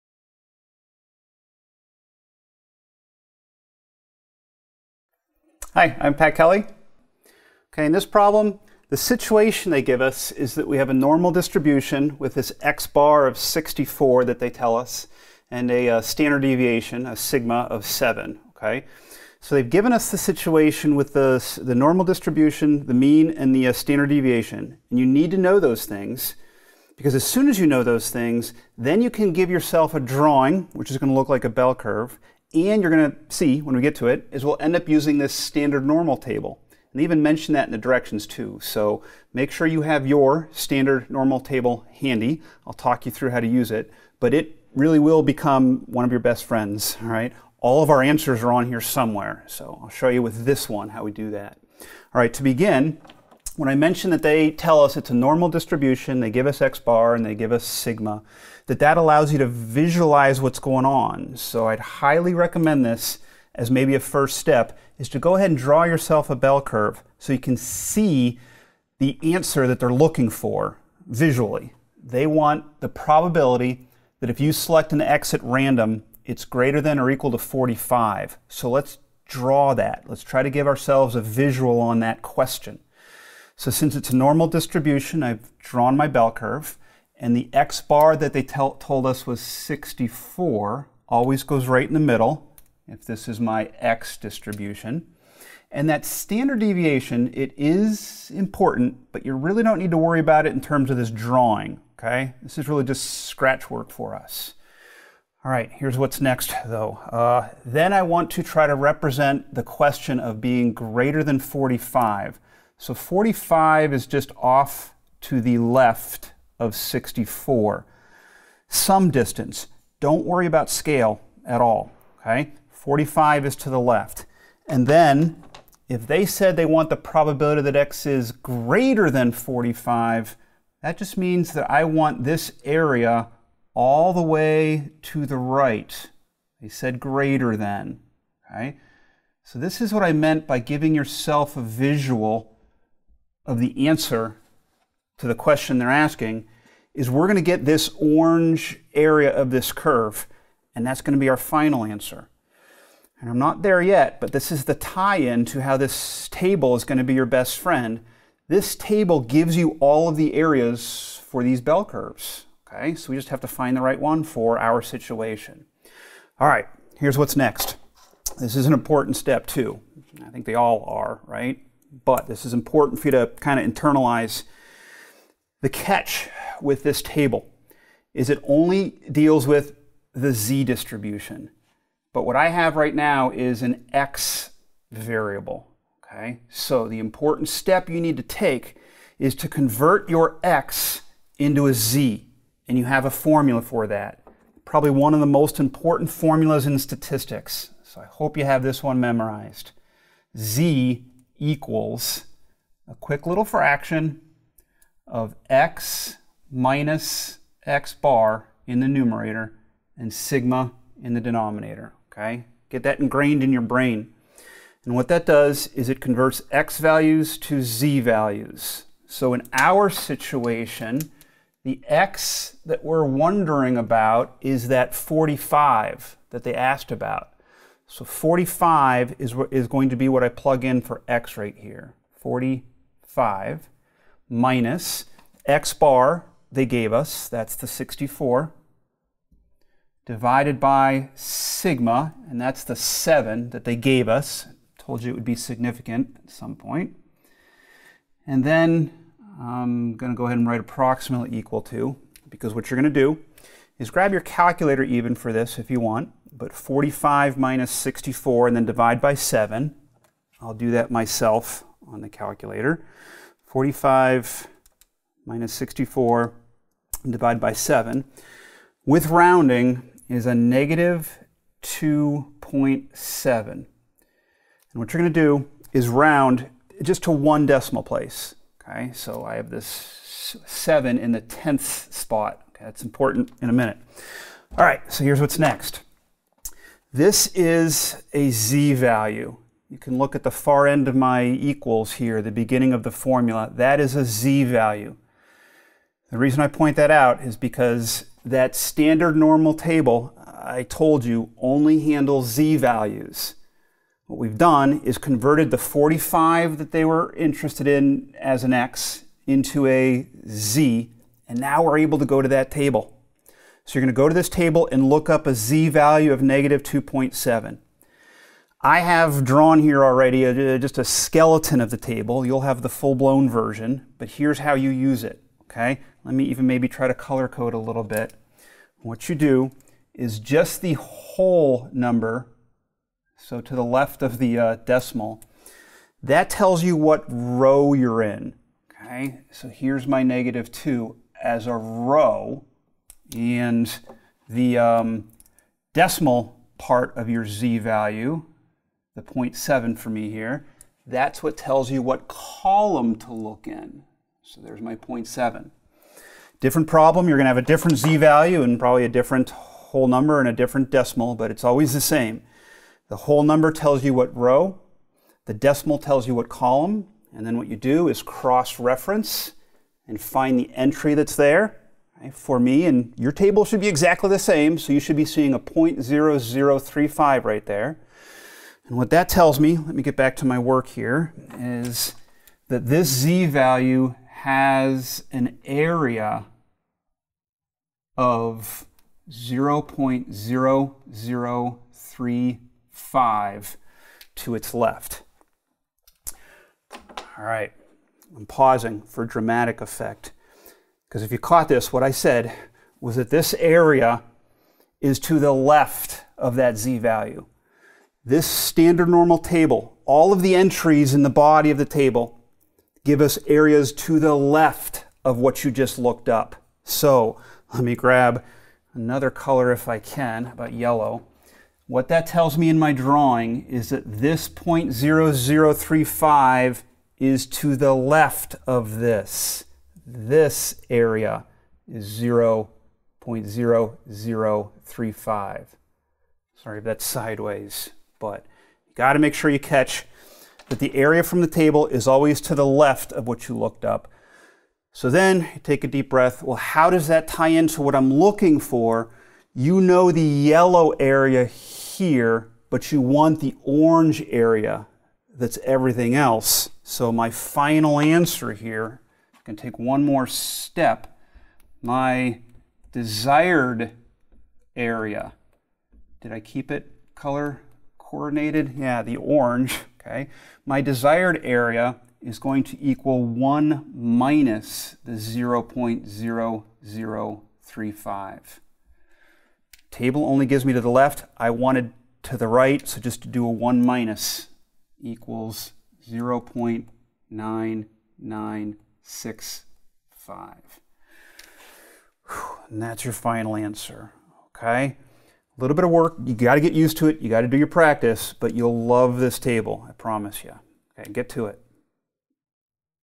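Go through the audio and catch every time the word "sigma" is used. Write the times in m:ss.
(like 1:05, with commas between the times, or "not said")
0:17, 0:57, 3:30, 4:01.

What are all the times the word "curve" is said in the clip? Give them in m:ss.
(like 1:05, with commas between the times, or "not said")
0:31, 1:06, 1:26, 2:29, 2:41.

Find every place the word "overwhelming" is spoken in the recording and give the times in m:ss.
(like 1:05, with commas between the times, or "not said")
not said.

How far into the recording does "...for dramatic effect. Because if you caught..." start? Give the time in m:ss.
6:38.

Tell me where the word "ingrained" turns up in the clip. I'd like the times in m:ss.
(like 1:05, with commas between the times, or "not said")
3:32.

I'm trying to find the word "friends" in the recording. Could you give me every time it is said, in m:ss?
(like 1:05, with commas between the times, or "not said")
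0:46, 2:37.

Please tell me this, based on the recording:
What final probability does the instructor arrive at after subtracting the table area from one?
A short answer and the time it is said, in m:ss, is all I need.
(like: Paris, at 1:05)
0.9965, at 8:05.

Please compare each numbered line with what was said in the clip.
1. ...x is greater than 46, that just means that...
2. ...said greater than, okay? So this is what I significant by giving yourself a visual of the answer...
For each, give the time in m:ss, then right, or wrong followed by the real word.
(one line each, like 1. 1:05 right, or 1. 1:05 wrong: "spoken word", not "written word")
1. 2:07 wrong: "45", not "46"
2. 2:16 wrong: "meant", not "significant".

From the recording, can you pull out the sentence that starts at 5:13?
So you're going to go to this table and look up a z value of negative 2.7.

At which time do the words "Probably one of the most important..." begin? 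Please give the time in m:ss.
3:14.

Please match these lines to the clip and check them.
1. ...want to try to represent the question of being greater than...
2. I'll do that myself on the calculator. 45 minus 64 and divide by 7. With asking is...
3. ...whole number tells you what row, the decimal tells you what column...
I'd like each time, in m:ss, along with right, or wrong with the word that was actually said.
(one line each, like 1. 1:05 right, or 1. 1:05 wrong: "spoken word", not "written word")
1. 1:48 right
2. 4:20 wrong: "rounding", not "asking"
3. 6:02 right.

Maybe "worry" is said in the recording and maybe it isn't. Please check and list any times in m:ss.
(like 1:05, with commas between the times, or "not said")
1:39, 2:00.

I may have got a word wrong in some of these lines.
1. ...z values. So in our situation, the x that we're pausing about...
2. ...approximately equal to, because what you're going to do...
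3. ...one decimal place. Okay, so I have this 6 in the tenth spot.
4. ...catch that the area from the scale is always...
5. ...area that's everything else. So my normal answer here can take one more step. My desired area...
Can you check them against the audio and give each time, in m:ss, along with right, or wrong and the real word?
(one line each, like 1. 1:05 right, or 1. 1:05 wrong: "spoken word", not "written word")
1. 3:37 wrong: "wondering", not "pausing"
2. 4:10 right
3. 4:37 wrong: "7", not "6"
4. 7:19 wrong: "table", not "scale"
5. 7:34 wrong: "final", not "normal".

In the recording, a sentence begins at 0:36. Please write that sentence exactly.
And they even mention that in the directions too.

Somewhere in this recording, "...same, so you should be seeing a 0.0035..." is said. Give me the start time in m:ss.
6:14.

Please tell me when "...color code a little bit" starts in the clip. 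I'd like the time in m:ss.
5:26.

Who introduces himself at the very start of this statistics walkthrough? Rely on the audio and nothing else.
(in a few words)
Pat Kelly.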